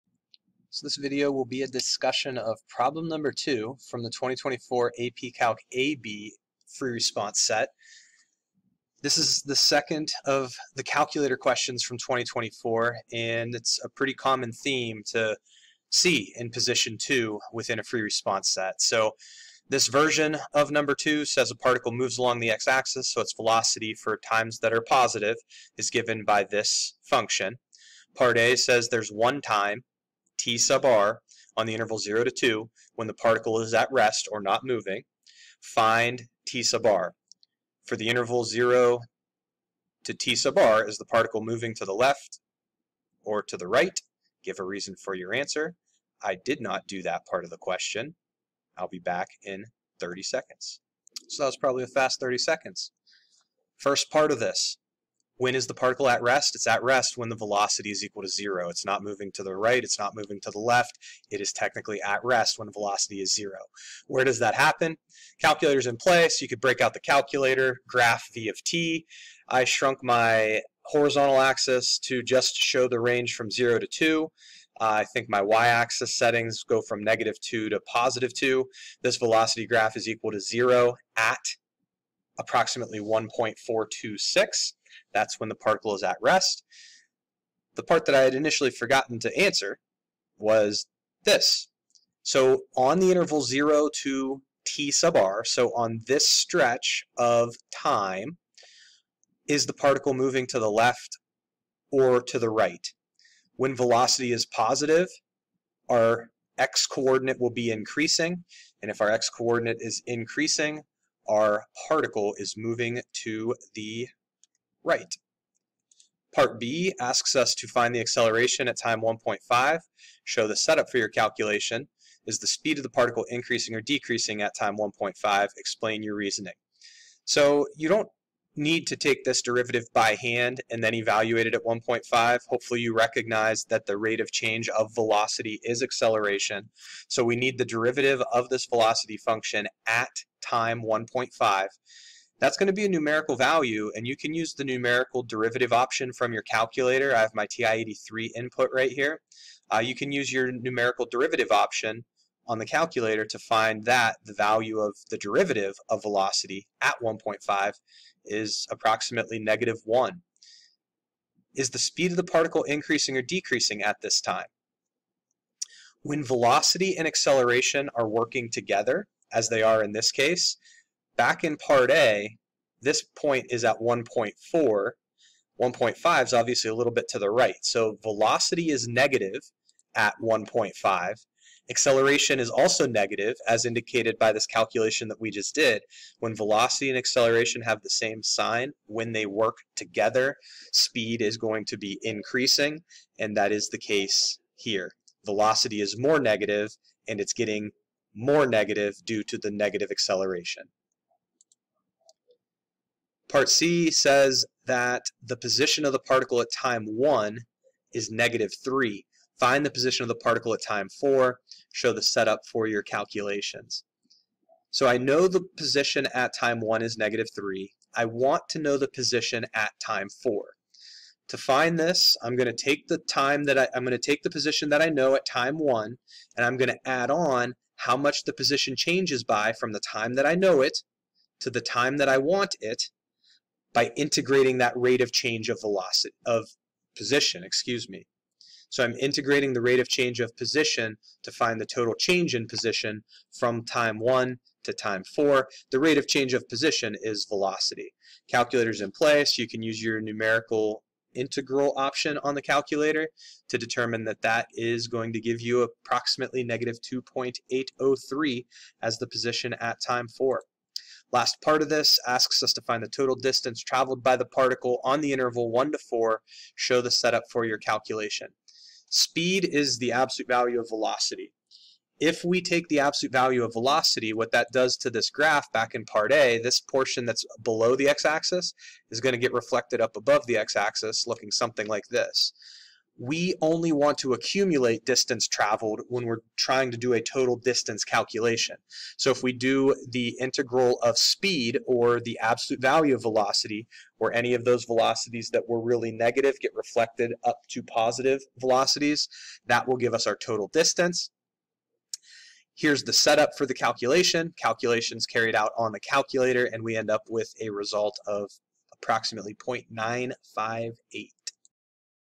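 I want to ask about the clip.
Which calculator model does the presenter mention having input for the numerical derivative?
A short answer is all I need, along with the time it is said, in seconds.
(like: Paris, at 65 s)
TI-83, at 147 s.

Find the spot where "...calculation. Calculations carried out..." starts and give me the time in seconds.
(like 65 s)
303 s.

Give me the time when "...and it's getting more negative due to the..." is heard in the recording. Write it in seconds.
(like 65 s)
197 s.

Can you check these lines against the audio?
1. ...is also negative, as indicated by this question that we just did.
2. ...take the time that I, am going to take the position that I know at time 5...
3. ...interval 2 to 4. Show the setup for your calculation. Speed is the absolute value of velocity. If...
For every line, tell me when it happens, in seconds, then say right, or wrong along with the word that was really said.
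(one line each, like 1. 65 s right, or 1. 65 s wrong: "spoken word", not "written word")
1. 182 s wrong: "calculation", not "question"
2. 222 s wrong: "1", not "5"
3. 265 s wrong: "1", not "2".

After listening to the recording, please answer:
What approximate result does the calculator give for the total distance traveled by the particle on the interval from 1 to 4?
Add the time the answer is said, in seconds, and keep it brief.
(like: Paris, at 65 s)
0.958, at 309 s.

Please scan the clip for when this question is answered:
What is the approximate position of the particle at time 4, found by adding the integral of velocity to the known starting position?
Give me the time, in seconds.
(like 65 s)
256 s.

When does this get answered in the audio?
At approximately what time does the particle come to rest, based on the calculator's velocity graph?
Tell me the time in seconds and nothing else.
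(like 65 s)
82 s.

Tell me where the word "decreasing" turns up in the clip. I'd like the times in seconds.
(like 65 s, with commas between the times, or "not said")
123 s, 163 s.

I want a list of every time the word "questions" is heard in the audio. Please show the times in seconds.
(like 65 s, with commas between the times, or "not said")
11 s, 47 s.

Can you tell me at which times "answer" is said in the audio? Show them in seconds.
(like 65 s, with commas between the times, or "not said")
45 s, 89 s.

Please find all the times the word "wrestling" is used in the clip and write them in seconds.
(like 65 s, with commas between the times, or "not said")
not said.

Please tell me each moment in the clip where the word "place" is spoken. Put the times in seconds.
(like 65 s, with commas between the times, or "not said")
65 s, 248 s.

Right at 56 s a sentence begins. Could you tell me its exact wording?
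It's at rest when the velocity is equal to zero.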